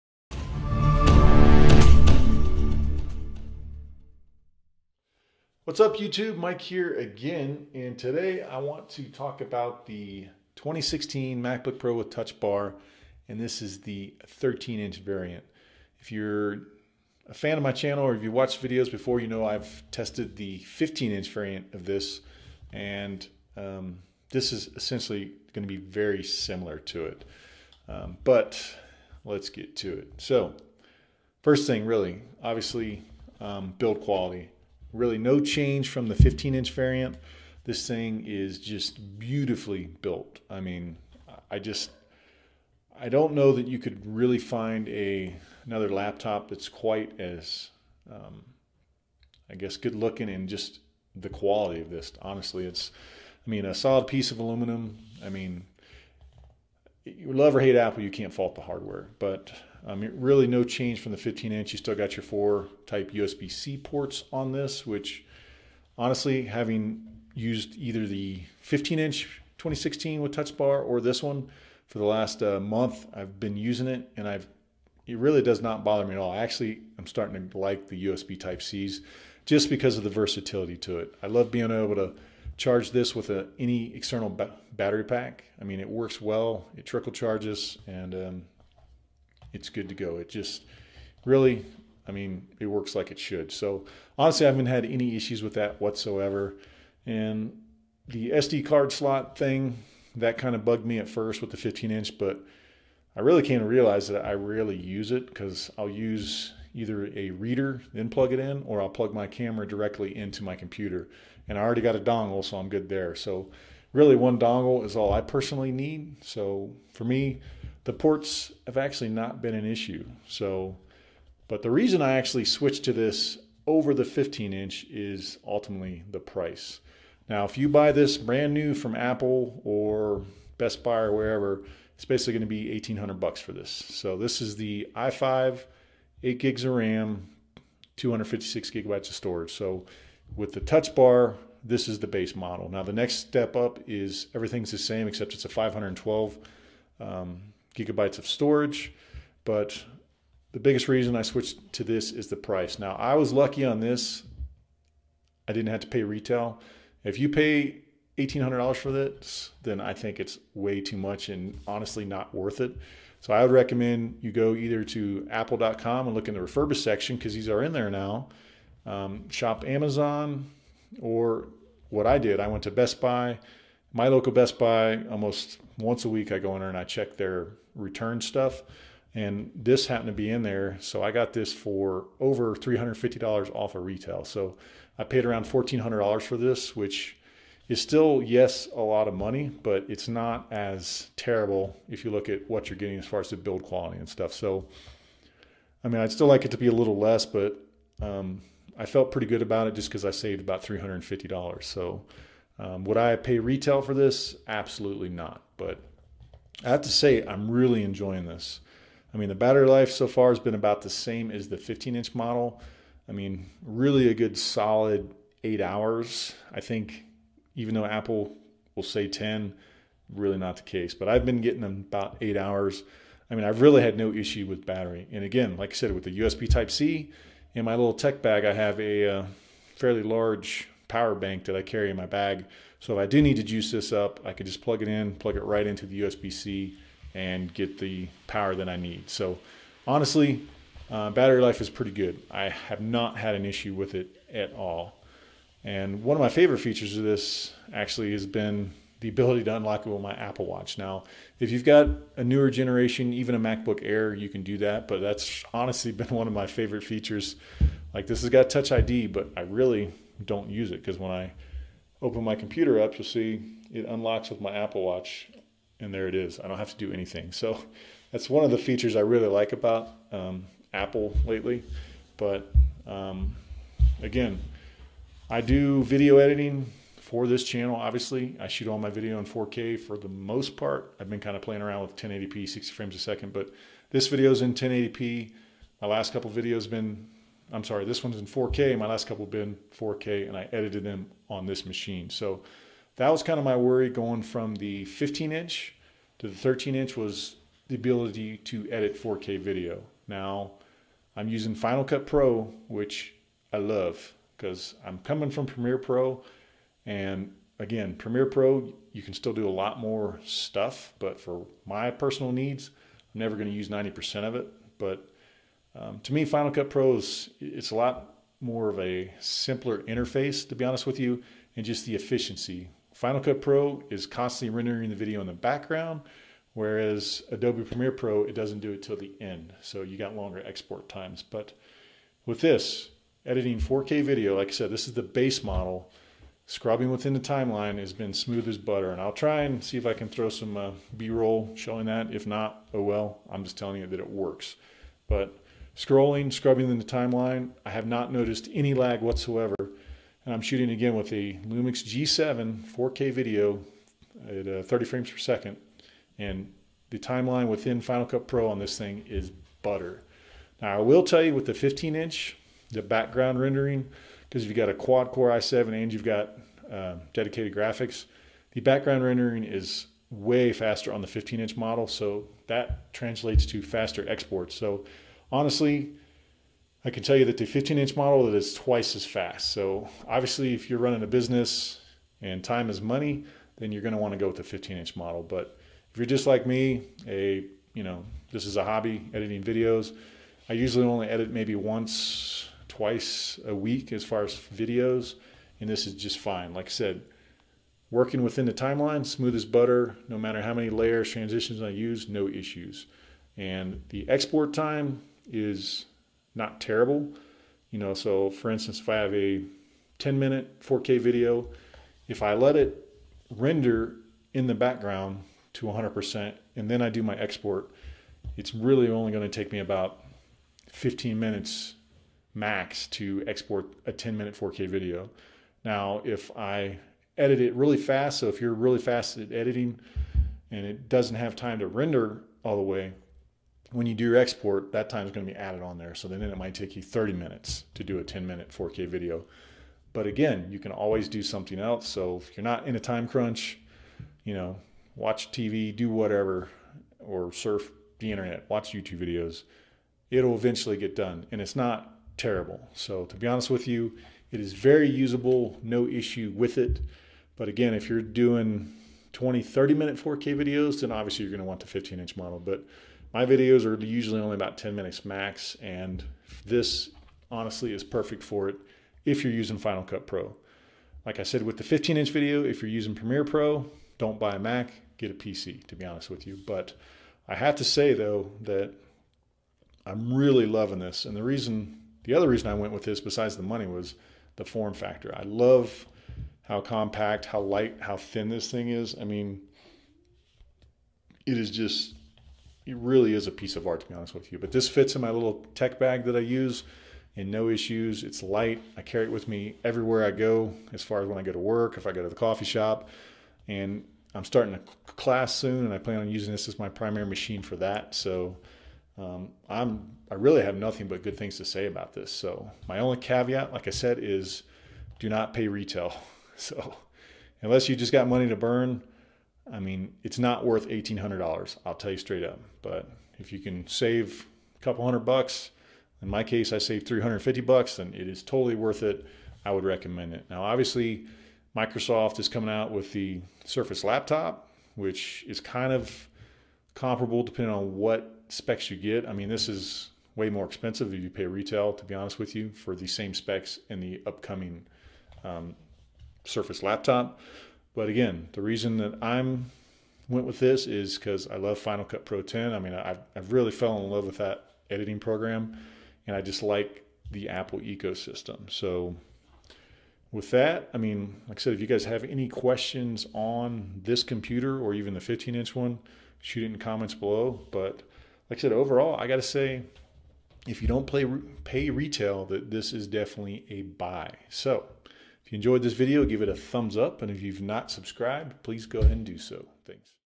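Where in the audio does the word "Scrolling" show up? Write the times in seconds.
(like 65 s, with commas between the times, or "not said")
345 s.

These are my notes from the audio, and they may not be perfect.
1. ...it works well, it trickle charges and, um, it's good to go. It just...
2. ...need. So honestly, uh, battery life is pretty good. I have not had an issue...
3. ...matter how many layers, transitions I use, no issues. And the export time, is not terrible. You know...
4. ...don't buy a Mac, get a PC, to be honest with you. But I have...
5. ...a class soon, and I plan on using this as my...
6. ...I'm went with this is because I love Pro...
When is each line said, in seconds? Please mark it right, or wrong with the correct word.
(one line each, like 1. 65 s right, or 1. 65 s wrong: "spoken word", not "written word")
1. 85 s right
2. 238 s right
3. 400 s right
4. 473 s right
5. 504 s right
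6. 549 s wrong: "Final", not "Pro".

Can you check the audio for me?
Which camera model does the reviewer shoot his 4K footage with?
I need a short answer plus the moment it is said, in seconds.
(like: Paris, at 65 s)
Lumix G7, at 351 s.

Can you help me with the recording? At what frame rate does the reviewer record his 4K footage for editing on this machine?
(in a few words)
30 frames per second.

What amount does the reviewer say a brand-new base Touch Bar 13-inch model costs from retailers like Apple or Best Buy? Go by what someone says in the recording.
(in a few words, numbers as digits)
$1,800.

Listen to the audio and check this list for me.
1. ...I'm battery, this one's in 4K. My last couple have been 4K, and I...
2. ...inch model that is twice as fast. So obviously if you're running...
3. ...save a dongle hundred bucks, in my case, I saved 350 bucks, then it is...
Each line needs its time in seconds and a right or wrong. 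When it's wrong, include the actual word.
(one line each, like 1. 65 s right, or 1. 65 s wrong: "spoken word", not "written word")
1. 287 s wrong: "sorry", not "battery"
2. 377 s right
3. 523 s wrong: "couple", not "dongle".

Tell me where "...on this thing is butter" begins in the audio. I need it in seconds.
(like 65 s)
358 s.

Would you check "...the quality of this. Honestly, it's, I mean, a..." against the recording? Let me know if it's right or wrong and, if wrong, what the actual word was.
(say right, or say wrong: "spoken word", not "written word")
right.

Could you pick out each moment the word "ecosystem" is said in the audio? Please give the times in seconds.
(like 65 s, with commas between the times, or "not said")
557 s.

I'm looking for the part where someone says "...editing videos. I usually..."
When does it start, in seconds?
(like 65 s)
389 s.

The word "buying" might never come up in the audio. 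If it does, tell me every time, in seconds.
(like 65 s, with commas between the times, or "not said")
not said.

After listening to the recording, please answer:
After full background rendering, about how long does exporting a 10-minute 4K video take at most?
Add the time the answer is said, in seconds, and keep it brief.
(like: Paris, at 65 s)
15 minutes, at 420 s.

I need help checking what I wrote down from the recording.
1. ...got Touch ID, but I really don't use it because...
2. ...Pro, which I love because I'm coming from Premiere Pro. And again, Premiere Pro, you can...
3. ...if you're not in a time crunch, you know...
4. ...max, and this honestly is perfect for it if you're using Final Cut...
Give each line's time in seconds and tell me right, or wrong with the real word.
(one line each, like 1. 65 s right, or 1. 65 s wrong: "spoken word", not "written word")
1. 258 s right
2. 302 s right
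3. 442 s right
4. 465 s right.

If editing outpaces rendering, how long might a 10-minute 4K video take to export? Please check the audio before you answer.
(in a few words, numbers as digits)
30 minutes.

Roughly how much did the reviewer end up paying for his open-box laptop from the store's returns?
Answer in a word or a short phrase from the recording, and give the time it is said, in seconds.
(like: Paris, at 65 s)
$1,400, at 185 s.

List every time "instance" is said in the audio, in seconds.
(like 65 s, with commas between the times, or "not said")
408 s.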